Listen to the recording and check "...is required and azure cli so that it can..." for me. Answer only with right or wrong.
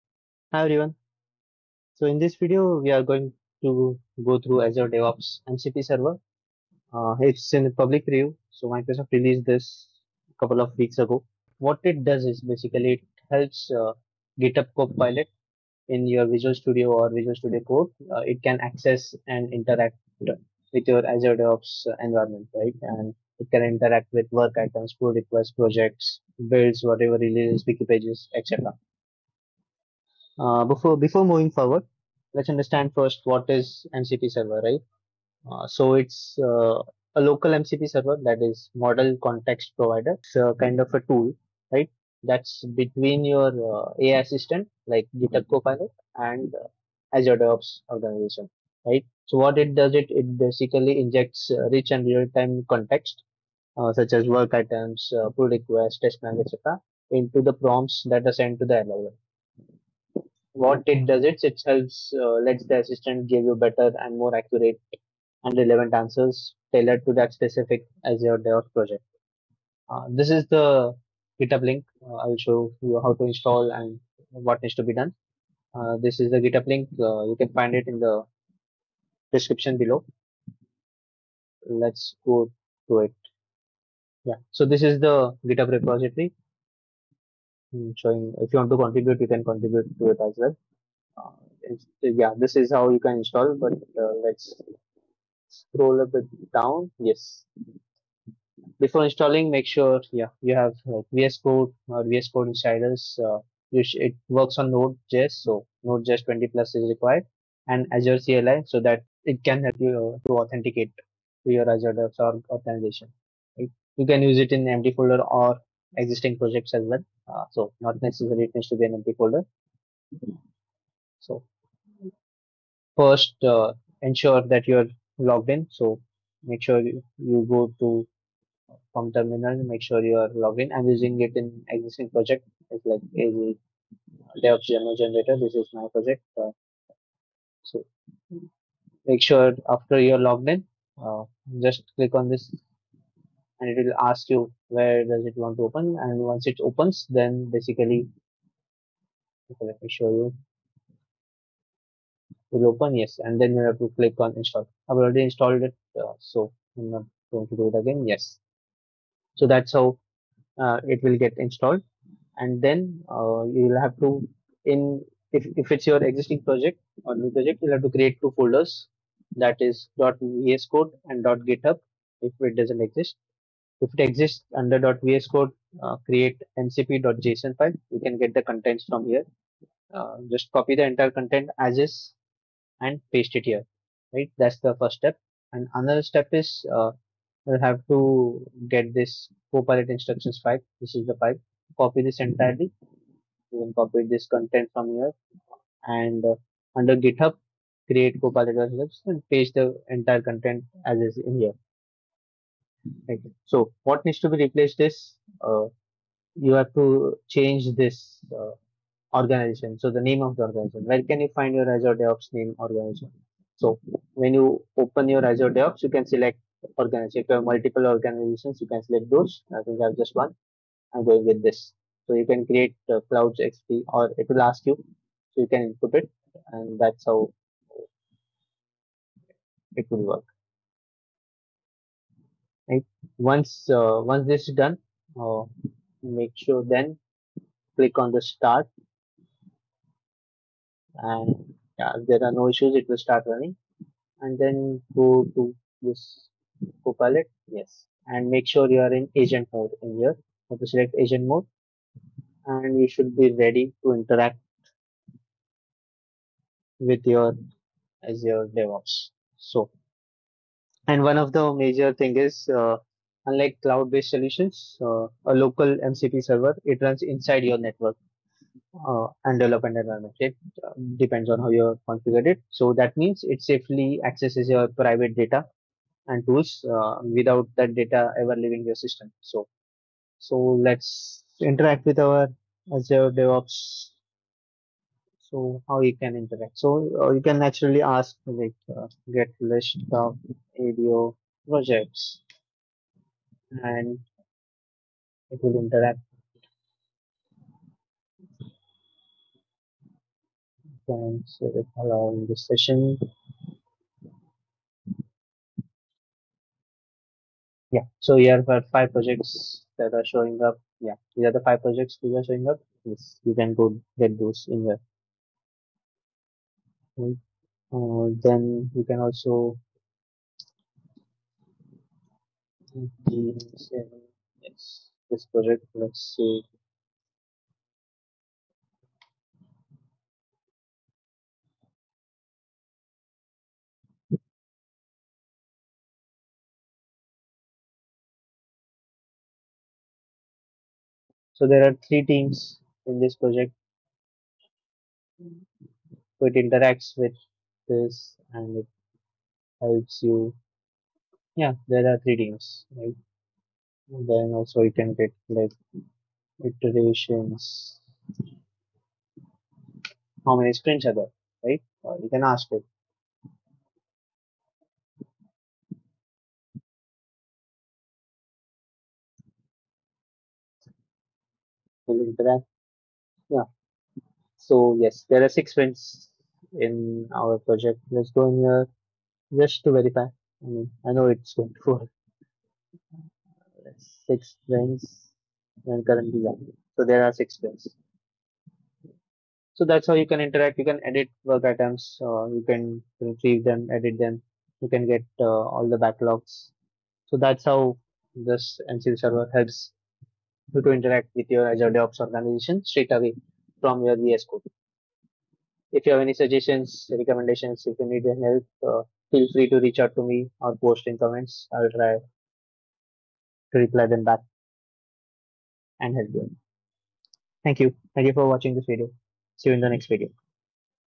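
right.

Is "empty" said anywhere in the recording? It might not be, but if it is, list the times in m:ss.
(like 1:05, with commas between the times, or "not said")
1:54, 1:58.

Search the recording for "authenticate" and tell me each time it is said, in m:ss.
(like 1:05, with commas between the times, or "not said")
1:50.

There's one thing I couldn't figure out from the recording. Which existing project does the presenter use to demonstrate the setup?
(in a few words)
DevOps generator.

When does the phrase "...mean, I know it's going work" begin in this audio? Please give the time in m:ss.
6:20.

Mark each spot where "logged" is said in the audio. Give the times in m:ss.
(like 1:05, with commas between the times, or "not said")
2:05, 2:10, 2:20.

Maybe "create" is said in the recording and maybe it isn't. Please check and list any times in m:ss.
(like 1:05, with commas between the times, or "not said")
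2:47, 2:56, 3:17, 3:42.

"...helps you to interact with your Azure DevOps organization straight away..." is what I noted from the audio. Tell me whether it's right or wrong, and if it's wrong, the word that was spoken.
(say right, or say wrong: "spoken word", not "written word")
right.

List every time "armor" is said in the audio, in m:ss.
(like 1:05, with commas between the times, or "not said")
not said.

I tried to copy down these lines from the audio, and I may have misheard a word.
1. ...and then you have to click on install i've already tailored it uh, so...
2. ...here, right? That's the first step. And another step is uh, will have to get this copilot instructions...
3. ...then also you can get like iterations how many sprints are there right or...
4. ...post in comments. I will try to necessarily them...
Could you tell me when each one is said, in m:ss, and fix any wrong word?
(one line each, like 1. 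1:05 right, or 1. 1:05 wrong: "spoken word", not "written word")
1. 2:33 wrong: "installed", not "tailored"
2. 3:03 right
3. 5:54 right
4. 6:50 wrong: "reply", not "necessarily".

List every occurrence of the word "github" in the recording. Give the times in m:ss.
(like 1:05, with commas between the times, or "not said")
0:14, 0:45, 1:11, 1:16, 1:25, 2:51, 3:16.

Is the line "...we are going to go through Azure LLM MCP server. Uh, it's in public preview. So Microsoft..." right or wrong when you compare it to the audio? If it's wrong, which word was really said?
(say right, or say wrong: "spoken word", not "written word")
wrong: "DevOps", not "LLM".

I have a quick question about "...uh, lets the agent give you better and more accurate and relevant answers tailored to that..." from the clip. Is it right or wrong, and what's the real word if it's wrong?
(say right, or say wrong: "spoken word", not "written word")
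wrong: "assistant", not "agent".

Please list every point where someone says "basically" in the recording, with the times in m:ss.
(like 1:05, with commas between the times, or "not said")
0:12, 0:50, 2:27.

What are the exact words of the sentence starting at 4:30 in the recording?
It uh, um, depends on how you configure it.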